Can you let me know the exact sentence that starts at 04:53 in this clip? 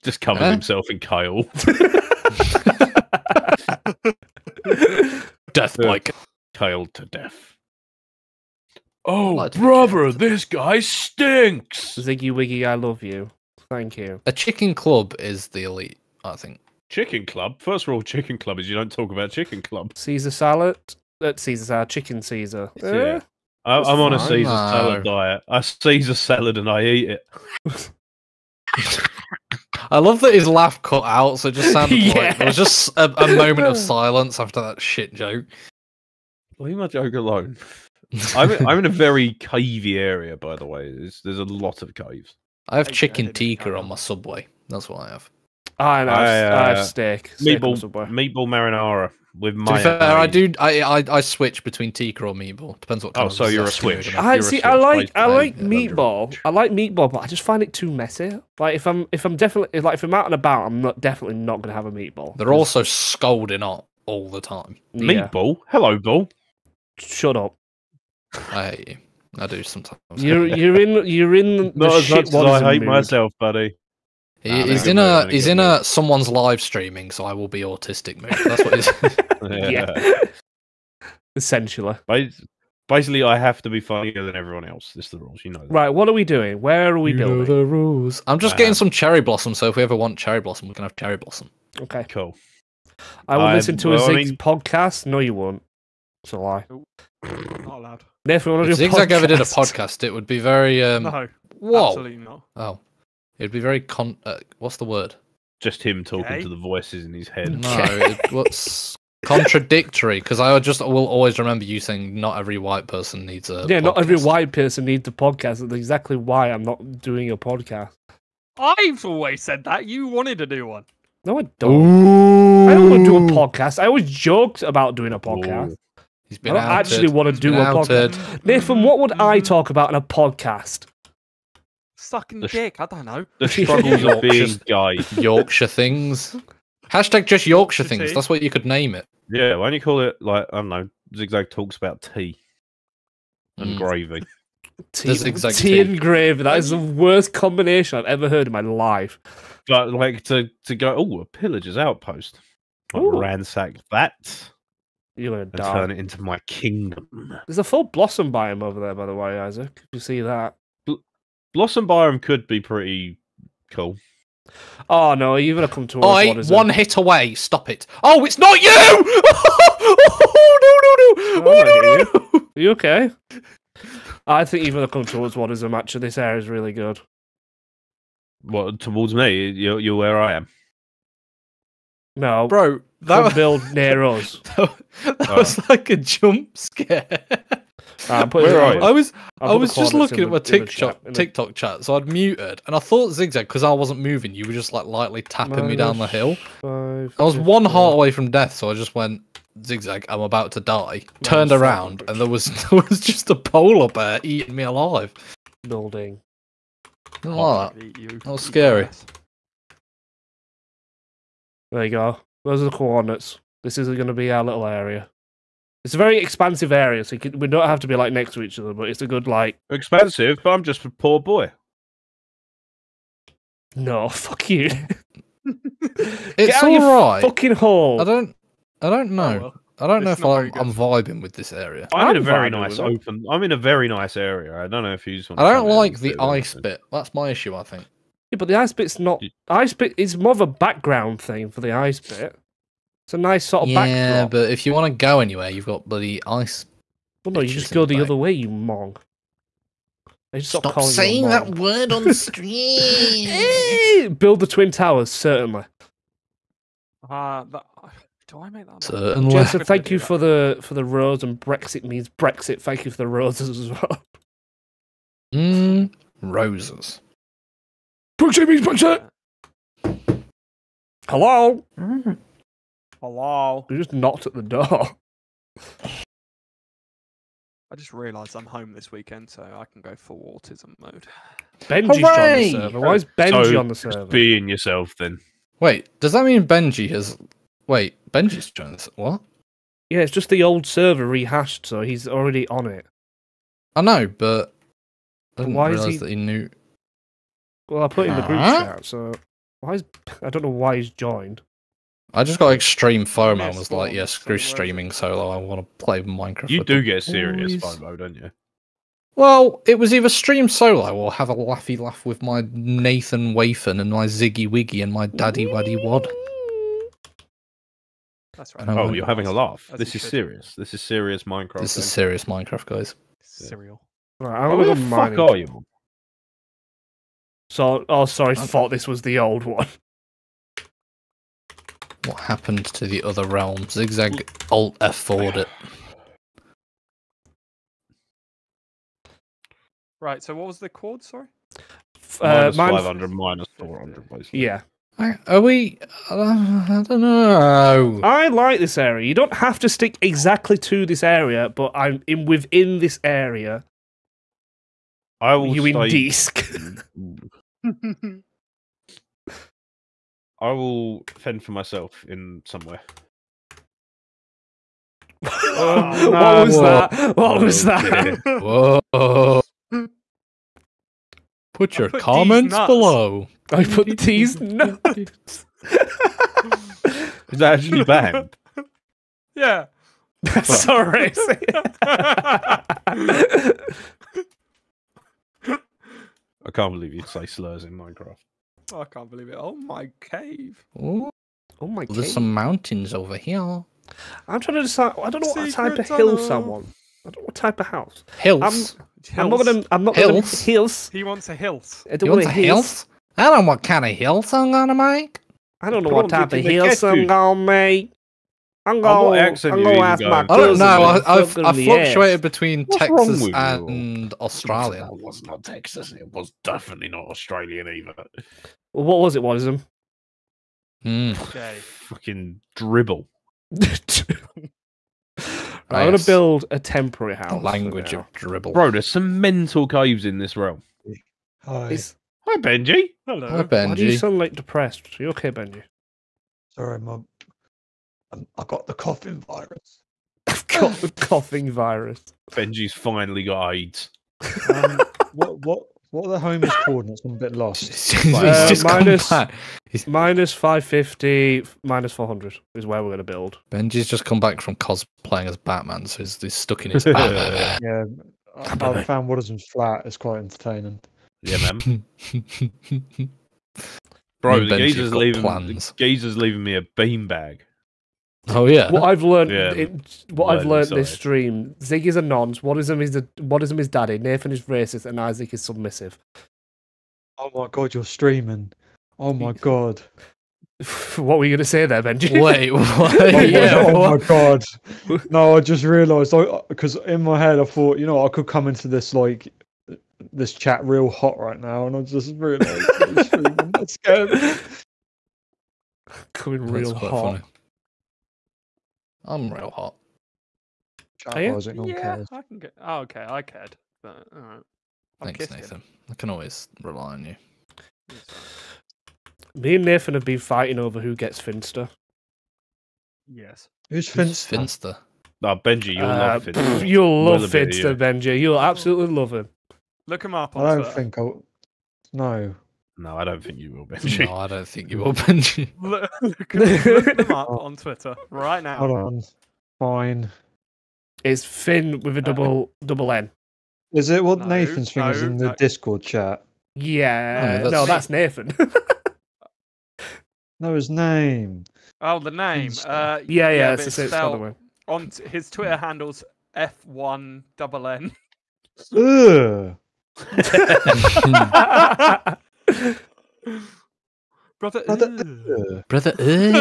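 I know, but I didn't why is he...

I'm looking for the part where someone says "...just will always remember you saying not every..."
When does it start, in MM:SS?
01:50.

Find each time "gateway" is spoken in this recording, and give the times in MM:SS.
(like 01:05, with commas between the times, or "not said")
not said.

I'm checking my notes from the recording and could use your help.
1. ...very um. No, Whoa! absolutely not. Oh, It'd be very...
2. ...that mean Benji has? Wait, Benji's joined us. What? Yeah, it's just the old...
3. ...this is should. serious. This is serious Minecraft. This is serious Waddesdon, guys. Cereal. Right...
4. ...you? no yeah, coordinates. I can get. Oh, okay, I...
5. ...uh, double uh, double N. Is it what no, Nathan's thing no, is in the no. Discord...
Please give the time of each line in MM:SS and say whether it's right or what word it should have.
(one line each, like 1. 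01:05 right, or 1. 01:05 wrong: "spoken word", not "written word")
1. 01:40 right
2. 04:46 right
3. 05:19 wrong: "Minecraft", not "Waddesdon"
4. 08:21 wrong: "cares", not "coordinates"
5. 08:51 right.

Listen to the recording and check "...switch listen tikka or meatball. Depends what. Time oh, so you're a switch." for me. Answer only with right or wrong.
wrong.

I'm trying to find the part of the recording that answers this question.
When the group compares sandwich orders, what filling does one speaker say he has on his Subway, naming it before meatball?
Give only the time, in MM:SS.
00:42.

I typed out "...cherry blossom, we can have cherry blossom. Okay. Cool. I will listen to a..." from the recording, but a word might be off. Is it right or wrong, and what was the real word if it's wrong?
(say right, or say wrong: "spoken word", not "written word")
right.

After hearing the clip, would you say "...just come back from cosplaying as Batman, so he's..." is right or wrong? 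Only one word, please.
right.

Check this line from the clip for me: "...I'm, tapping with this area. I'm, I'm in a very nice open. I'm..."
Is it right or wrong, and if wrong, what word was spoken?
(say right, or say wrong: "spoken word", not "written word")
wrong: "vibing", not "tapping".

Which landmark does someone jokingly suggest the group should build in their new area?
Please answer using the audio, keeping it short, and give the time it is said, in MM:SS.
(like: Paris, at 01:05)
Twin towers, at 04:14.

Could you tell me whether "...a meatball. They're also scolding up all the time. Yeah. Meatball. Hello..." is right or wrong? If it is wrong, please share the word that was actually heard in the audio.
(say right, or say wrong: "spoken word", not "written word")
right.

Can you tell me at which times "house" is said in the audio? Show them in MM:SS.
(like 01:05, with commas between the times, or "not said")
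06:37, 07:07.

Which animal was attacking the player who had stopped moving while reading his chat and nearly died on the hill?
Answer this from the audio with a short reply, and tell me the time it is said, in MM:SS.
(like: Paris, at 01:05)
Polar bear, at 03:23.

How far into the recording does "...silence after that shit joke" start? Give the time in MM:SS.
00:33.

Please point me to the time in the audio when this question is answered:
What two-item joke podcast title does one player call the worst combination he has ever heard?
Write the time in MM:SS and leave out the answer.
02:24.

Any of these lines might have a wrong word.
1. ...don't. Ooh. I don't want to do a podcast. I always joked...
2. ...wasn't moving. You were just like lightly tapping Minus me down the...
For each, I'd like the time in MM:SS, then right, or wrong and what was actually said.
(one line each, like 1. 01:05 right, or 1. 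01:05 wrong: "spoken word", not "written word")
1. 02:01 right
2. 03:13 right.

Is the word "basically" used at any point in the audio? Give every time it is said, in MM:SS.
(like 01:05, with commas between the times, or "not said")
01:22, 05:44.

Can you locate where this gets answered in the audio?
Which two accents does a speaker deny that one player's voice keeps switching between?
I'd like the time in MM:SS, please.
06:52.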